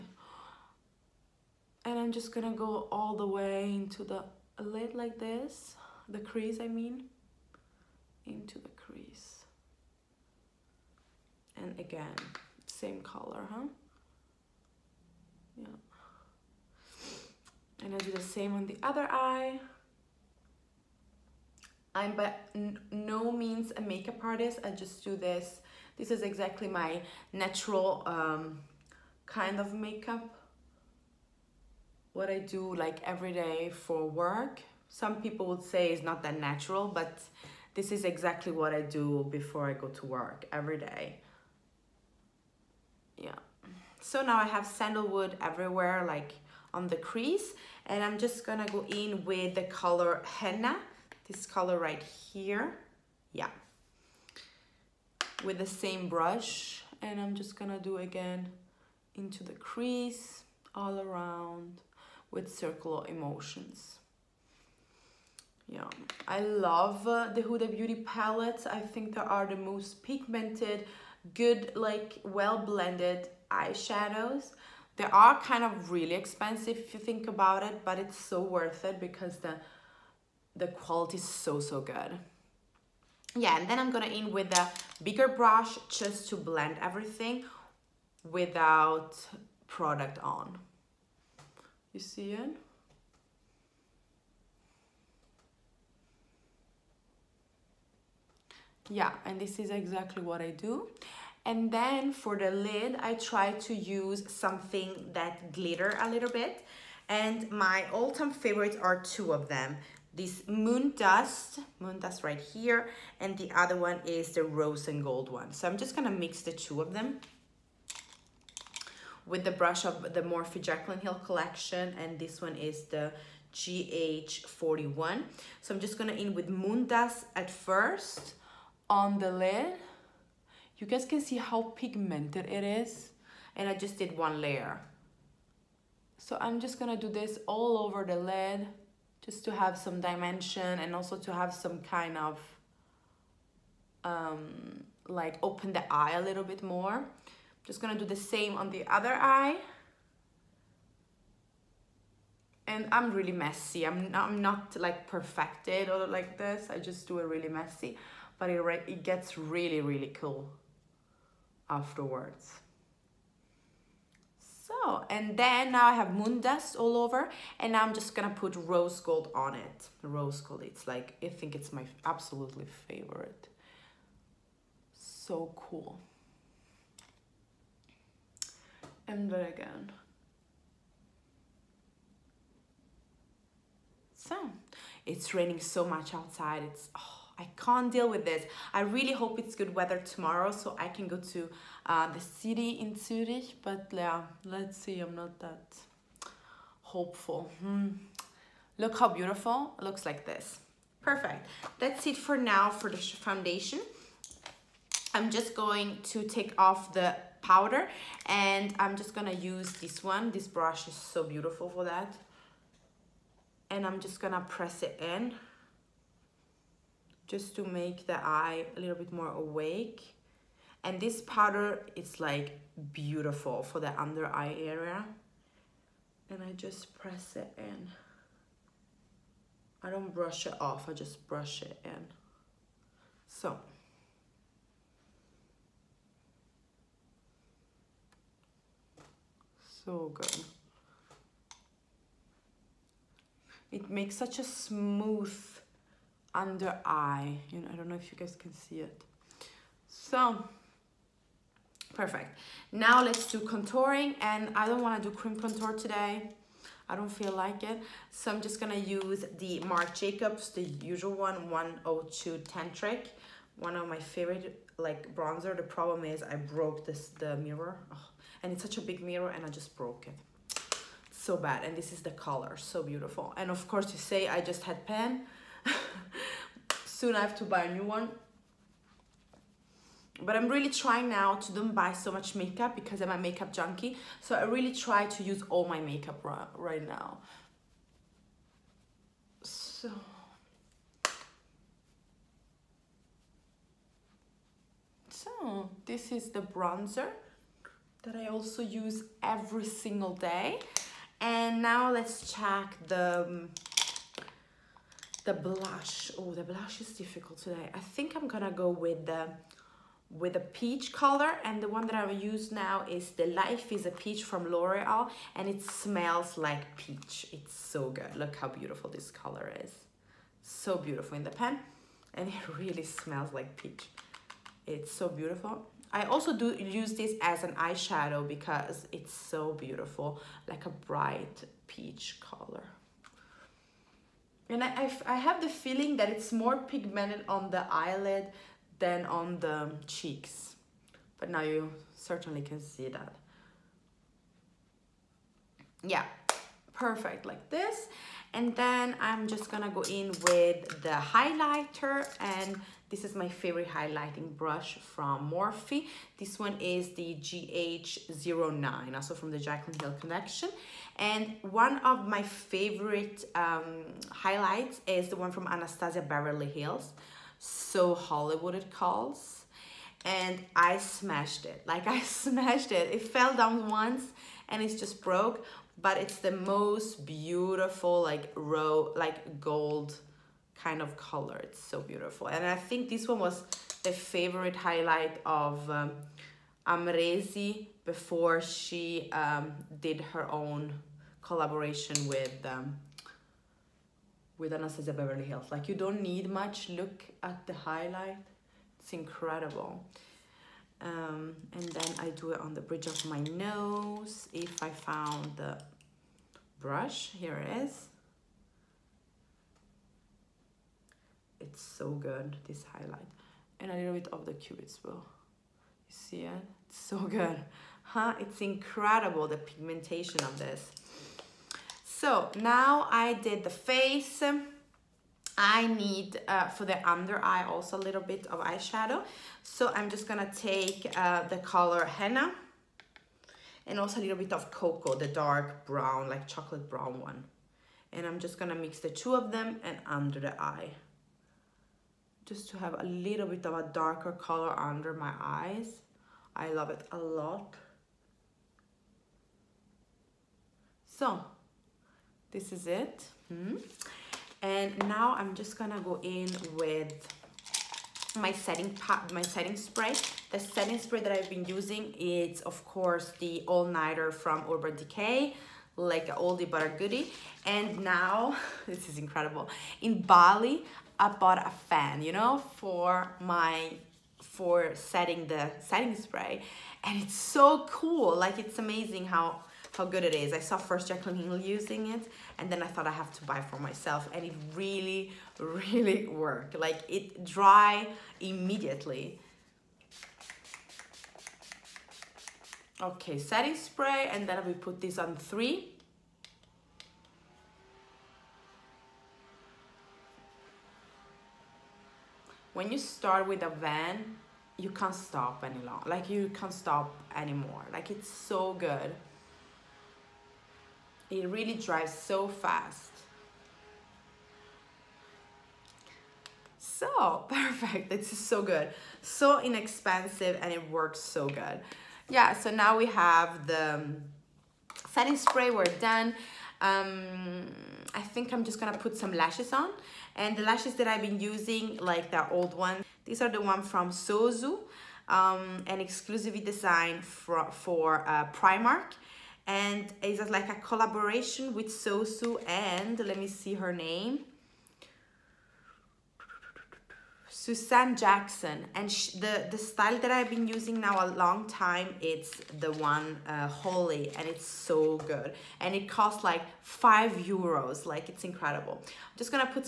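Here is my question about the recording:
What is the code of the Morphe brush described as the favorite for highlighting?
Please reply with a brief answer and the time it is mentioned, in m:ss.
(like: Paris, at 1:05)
GH09, at 5:57.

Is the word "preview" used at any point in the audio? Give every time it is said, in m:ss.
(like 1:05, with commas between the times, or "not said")
not said.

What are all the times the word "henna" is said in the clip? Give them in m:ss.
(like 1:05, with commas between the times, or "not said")
0:50, 7:11.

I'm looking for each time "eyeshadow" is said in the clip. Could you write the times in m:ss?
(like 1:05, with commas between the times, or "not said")
1:13, 5:27, 7:08.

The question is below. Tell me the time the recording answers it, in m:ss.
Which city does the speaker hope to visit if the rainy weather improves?
3:12.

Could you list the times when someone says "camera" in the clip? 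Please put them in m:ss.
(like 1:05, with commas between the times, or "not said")
not said.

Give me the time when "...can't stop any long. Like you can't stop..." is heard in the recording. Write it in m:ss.
8:24.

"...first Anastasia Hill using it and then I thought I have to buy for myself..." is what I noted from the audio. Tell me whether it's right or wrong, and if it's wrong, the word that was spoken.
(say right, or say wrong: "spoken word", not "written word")
wrong: "Jaclyn", not "Anastasia".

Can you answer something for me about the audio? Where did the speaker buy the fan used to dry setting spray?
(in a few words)
Bali.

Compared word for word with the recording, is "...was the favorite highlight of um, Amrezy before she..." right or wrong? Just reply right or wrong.
right.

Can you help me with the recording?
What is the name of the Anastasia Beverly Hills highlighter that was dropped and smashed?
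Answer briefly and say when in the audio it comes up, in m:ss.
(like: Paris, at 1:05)
So Hollywood, at 6:07.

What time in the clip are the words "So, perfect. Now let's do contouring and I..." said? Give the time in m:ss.
4:09.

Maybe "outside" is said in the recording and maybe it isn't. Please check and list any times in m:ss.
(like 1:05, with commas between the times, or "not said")
3:06.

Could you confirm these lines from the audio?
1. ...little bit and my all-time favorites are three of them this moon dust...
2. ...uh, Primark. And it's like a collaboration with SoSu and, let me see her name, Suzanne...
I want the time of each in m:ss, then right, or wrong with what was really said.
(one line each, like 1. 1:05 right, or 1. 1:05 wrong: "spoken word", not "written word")
1. 1:46 wrong: "two", not "three"
2. 8:58 right.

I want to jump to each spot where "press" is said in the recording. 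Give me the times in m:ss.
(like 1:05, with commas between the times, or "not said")
3:34, 3:46.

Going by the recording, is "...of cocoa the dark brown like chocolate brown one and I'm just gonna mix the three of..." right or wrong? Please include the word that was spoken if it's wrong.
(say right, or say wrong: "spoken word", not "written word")
wrong: "two", not "three".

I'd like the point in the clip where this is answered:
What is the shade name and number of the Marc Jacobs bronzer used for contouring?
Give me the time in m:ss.
4:21.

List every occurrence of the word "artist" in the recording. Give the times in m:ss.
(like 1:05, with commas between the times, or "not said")
0:24.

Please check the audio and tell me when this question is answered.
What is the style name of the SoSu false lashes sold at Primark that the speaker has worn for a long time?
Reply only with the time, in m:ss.
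9:13.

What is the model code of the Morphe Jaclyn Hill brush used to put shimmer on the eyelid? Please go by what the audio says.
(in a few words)
GH41.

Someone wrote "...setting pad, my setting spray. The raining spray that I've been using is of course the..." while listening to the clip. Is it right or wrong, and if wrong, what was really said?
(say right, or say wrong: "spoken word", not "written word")
wrong: "setting", not "raining".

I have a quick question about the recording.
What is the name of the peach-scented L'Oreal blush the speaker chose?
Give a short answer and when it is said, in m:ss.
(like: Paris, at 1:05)
Life is a Peach, at 5:13.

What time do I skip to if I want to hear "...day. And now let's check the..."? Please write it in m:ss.
5:00.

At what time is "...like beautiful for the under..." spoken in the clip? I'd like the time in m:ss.
3:42.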